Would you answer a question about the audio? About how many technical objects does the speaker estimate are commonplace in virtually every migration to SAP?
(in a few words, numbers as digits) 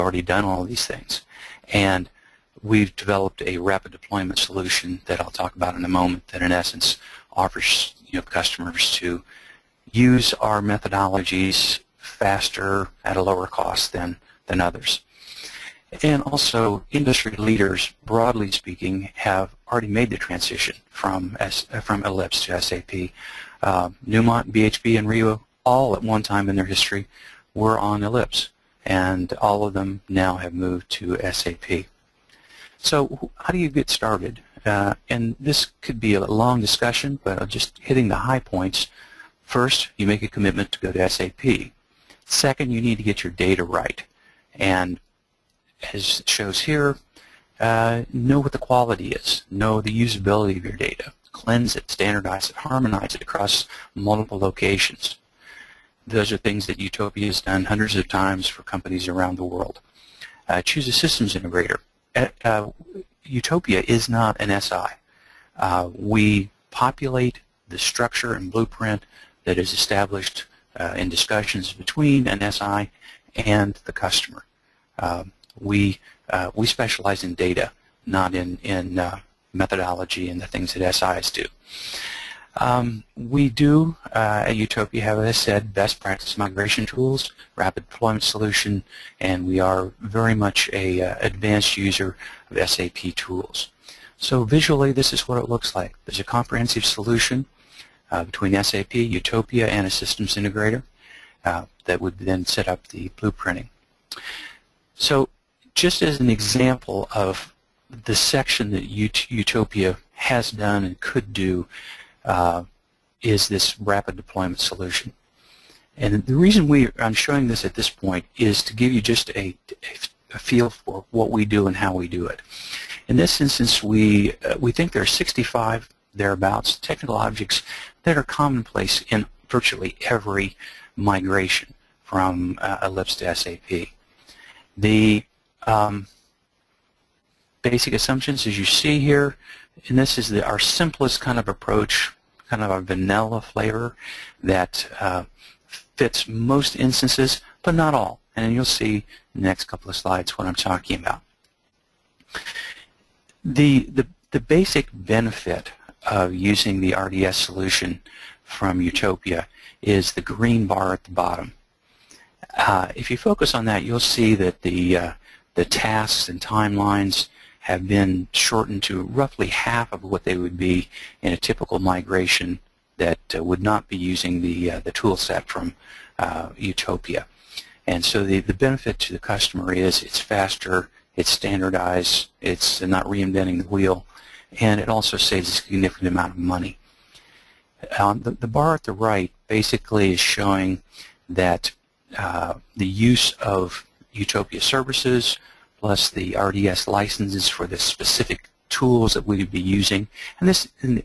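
65.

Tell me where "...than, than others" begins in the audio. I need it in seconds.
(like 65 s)
13 s.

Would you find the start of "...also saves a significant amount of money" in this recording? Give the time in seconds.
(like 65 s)
184 s.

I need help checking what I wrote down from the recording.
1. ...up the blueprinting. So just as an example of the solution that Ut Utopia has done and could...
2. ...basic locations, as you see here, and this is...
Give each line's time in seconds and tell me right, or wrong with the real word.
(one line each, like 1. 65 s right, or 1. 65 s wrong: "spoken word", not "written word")
1. 102 s wrong: "section", not "solution"
2. 137 s wrong: "assumptions", not "locations".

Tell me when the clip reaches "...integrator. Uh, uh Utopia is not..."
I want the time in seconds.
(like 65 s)
61 s.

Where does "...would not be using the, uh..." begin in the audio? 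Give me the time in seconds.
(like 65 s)
173 s.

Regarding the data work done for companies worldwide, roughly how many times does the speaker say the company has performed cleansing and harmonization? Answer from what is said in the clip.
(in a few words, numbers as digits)
hundreds of times.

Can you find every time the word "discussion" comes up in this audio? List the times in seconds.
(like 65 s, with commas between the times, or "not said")
36 s, 71 s.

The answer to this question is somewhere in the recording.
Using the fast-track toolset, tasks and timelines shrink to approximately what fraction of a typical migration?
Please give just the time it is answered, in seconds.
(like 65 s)
169 s.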